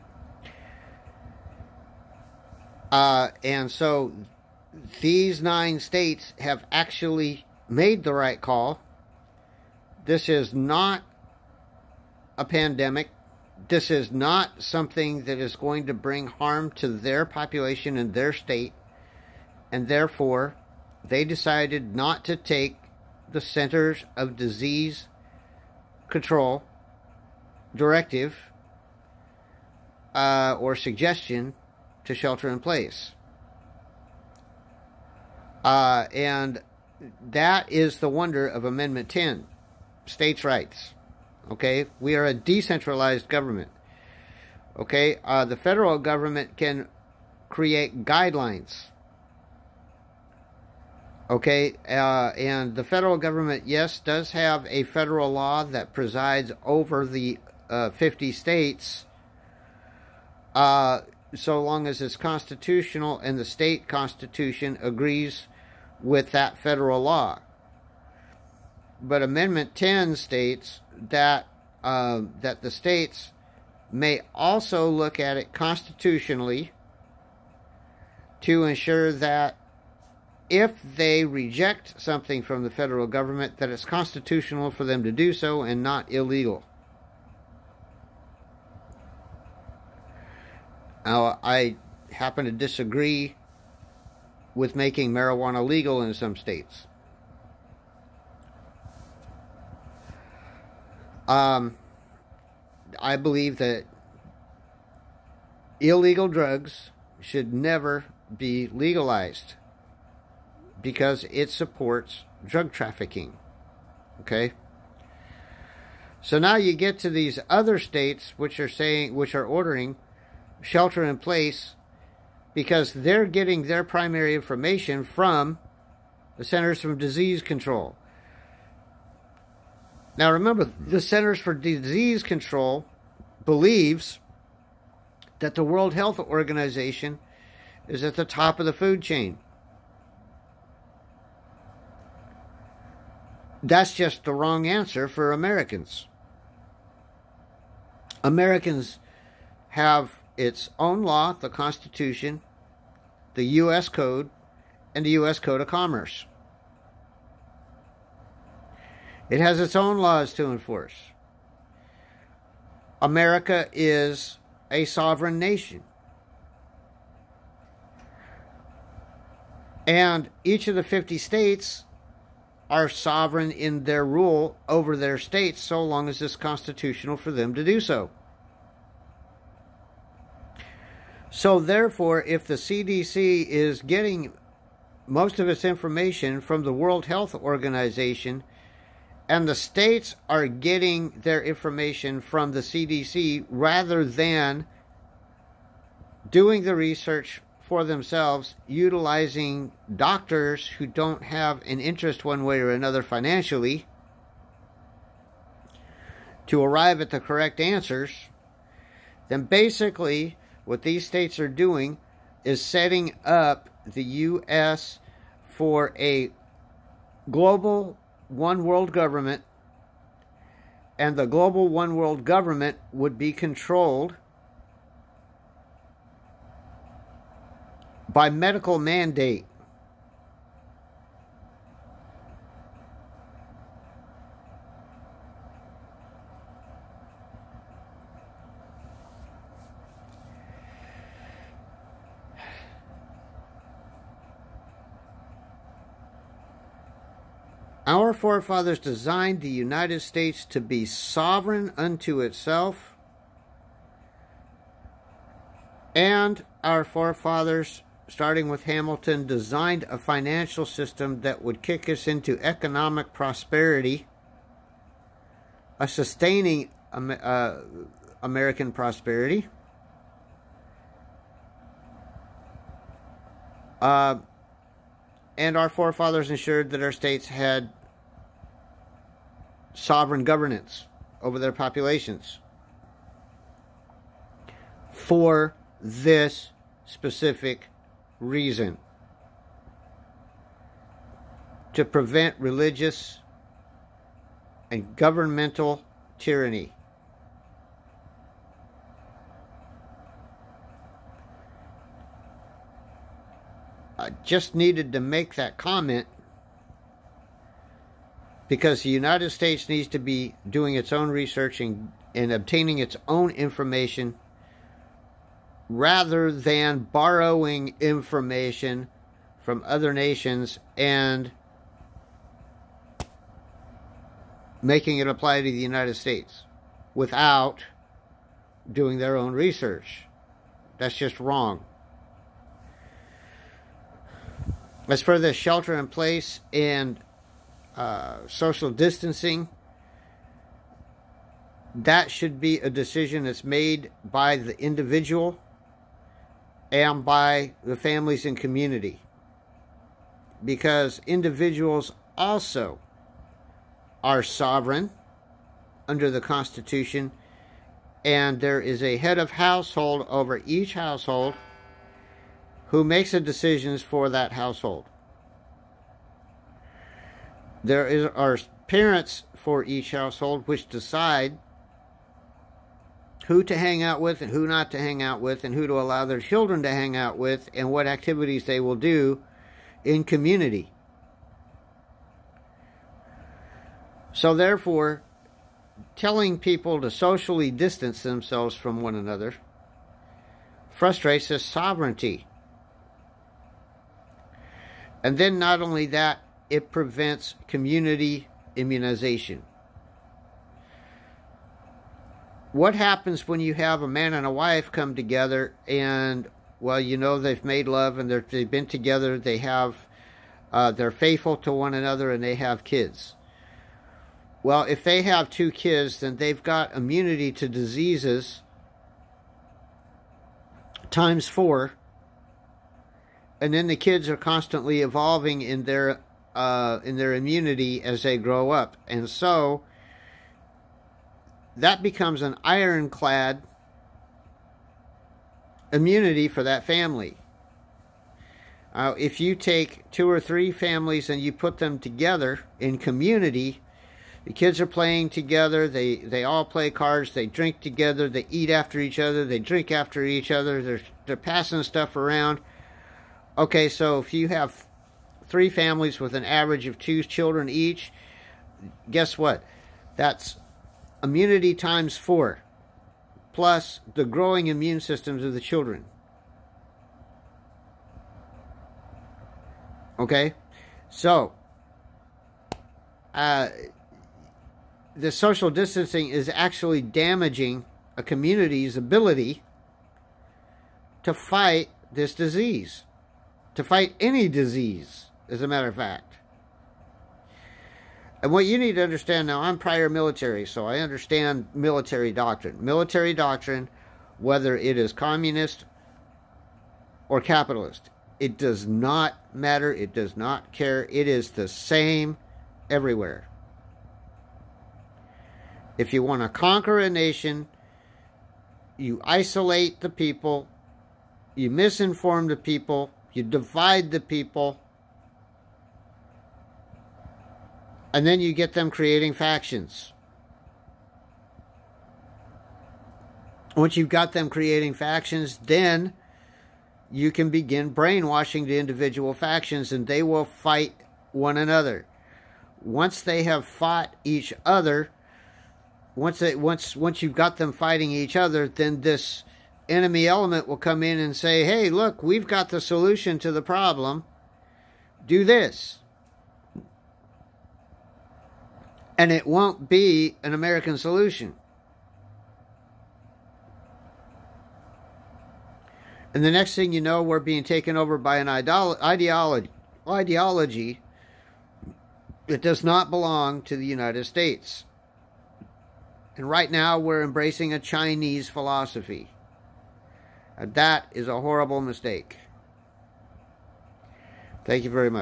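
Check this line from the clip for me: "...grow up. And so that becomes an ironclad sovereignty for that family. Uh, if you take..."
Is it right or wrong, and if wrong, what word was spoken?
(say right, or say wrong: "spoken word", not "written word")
wrong: "immunity", not "sovereignty".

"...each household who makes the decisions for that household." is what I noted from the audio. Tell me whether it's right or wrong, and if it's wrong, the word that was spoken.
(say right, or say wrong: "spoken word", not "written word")
right.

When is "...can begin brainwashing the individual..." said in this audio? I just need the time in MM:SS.
08:47.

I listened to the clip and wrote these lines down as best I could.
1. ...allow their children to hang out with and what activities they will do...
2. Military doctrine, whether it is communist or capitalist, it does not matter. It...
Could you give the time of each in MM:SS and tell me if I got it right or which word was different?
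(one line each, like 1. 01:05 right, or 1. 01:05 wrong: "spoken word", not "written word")
1. 06:15 right
2. 08:12 right.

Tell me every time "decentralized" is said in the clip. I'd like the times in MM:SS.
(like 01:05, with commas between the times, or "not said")
00:42.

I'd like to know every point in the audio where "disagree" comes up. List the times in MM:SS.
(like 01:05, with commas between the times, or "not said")
01:32.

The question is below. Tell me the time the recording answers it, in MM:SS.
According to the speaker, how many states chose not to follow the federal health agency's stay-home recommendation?
00:05.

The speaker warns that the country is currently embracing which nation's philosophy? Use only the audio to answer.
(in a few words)
Chinese.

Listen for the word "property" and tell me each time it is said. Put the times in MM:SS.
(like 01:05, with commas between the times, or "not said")
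not said.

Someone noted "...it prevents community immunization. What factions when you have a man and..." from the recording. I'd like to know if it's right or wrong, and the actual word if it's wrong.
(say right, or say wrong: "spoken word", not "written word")
wrong: "happens", not "factions".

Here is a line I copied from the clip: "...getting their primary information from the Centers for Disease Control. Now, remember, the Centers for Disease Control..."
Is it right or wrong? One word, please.
right.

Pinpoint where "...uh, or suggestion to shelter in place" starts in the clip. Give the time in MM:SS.
00:30.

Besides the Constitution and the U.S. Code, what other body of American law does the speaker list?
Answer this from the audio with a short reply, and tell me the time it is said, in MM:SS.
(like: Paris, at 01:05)
U.S. Code of Commerce, at 02:35.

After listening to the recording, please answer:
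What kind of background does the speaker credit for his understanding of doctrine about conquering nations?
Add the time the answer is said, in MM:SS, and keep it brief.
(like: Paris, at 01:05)
prior military, at 08:09.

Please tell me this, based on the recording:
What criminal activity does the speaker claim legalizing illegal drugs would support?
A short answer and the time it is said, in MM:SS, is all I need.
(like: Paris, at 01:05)
drug trafficking, at 01:52.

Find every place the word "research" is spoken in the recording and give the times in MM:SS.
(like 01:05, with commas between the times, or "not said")
03:16, 05:11, 05:29.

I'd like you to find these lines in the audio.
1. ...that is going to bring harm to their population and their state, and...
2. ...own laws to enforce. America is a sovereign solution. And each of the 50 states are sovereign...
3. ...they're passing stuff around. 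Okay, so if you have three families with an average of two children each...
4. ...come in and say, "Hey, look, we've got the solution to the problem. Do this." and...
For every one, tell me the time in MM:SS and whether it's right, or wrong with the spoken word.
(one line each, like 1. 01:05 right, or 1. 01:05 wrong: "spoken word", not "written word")
1. 00:15 right
2. 02:39 wrong: "nation", not "solution"
3. 07:31 right
4. 09:00 right.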